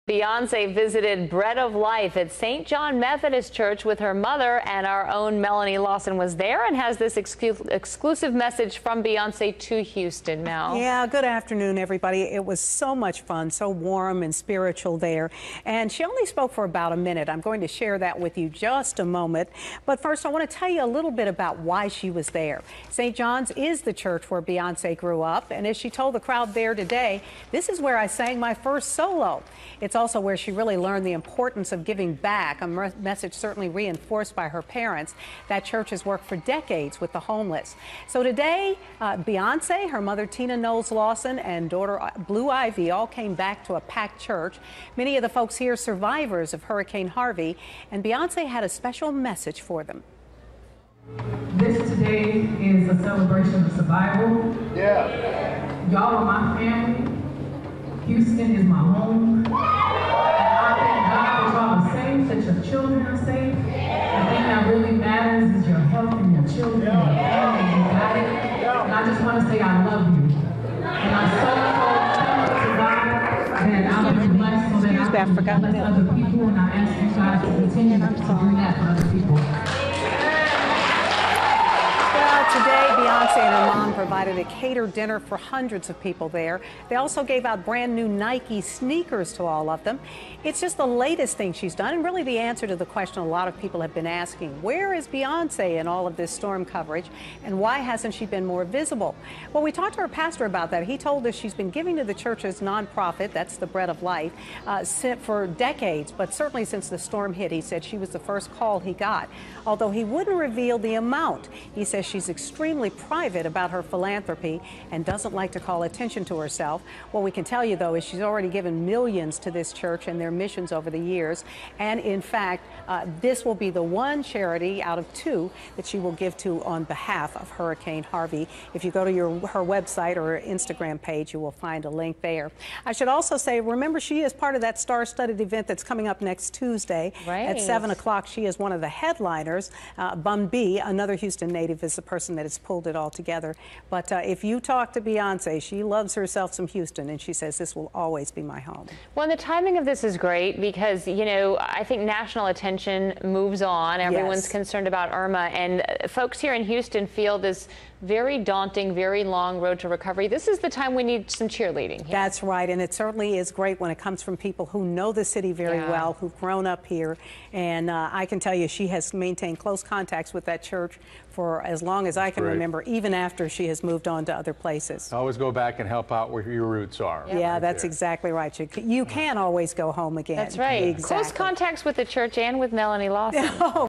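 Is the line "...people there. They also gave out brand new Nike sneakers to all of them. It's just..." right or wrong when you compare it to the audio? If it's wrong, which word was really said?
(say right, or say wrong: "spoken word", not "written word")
right.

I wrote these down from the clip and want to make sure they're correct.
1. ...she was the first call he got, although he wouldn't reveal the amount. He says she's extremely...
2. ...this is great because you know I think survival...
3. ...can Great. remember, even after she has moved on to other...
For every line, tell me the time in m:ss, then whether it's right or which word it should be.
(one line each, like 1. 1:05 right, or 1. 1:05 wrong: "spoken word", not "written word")
1. 1:47 right
2. 2:29 wrong: "national", not "survival"
3. 2:52 right.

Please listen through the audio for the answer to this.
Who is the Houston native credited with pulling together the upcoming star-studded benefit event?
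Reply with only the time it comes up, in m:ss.
2:20.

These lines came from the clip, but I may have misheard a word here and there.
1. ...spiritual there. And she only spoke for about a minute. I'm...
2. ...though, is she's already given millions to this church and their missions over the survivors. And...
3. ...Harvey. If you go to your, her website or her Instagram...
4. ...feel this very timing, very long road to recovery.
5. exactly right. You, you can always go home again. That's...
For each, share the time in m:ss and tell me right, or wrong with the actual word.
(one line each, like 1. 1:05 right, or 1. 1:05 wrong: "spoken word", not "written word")
1. 0:14 right
2. 1:57 wrong: "years", not "survivors"
3. 2:08 right
4. 2:37 wrong: "daunting", not "timing"
5. 2:57 right.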